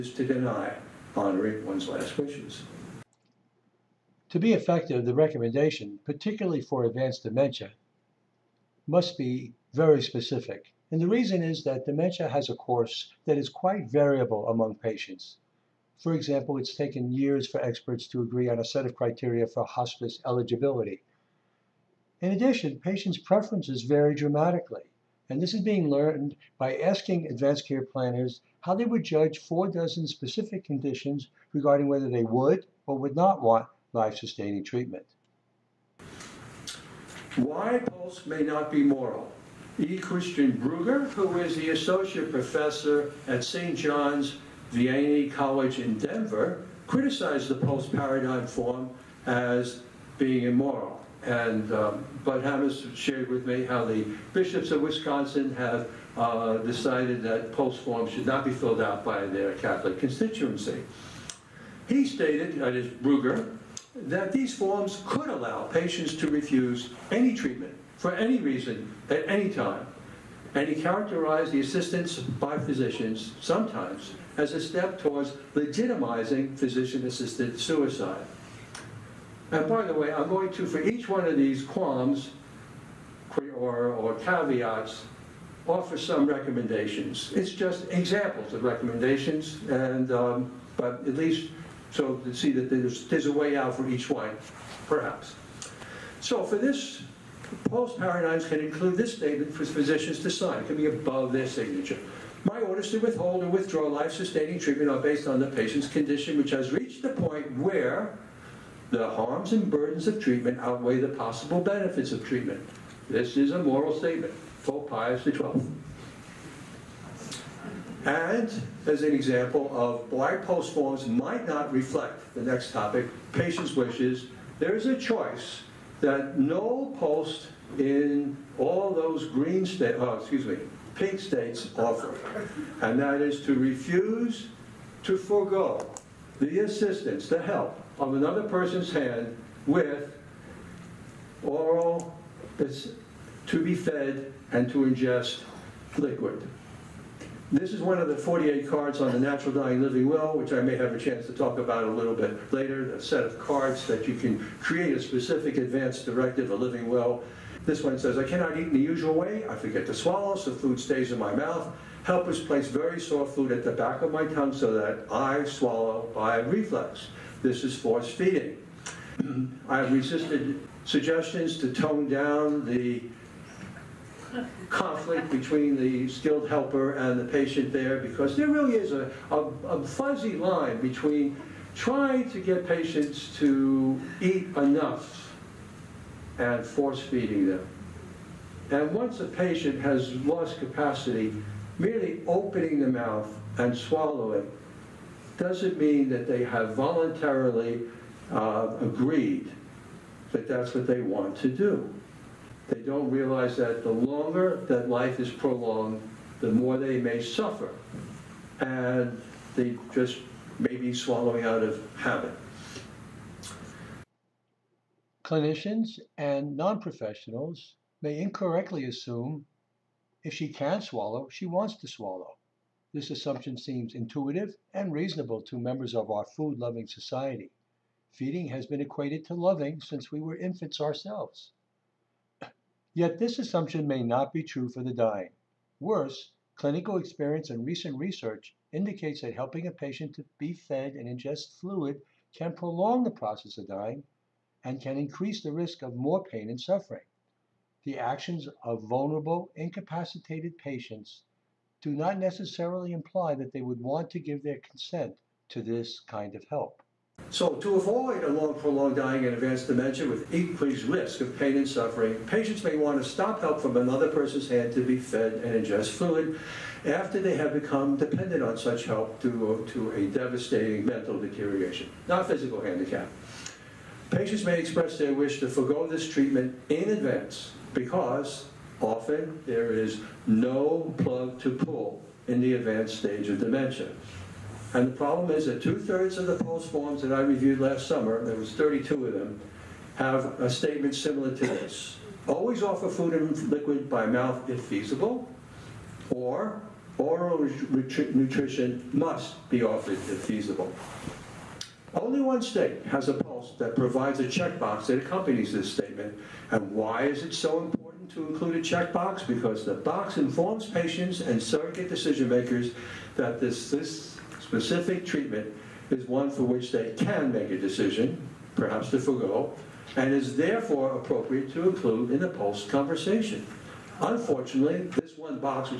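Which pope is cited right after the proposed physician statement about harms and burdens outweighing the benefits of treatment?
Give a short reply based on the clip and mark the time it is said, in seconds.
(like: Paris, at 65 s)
Pope Pius XII, at 114 s.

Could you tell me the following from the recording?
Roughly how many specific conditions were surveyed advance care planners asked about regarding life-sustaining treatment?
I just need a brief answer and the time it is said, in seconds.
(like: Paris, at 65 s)
48, at 29 s.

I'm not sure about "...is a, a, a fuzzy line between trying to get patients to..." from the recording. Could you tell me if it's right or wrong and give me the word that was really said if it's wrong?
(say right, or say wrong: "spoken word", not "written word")
right.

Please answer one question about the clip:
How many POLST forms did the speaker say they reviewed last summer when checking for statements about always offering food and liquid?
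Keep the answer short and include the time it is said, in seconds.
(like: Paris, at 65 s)
32, at 288 s.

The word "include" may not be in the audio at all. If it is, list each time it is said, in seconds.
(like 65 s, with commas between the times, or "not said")
98 s, 308 s, 321 s.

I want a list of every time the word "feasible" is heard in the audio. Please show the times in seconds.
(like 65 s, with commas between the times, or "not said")
294 s, 300 s.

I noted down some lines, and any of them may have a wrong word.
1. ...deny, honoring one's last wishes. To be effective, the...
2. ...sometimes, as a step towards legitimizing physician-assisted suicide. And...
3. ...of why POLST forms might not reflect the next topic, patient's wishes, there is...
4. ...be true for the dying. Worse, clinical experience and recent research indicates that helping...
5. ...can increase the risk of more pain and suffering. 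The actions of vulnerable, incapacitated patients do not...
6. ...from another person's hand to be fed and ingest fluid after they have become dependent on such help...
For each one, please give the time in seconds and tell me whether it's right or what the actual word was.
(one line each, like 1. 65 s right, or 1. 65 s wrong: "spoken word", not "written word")
1. 0 s right
2. 73 s right
3. 119 s right
4. 234 s right
5. 244 s right
6. 263 s right.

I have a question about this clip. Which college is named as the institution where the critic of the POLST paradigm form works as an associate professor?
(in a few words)
St. John's Vianney College.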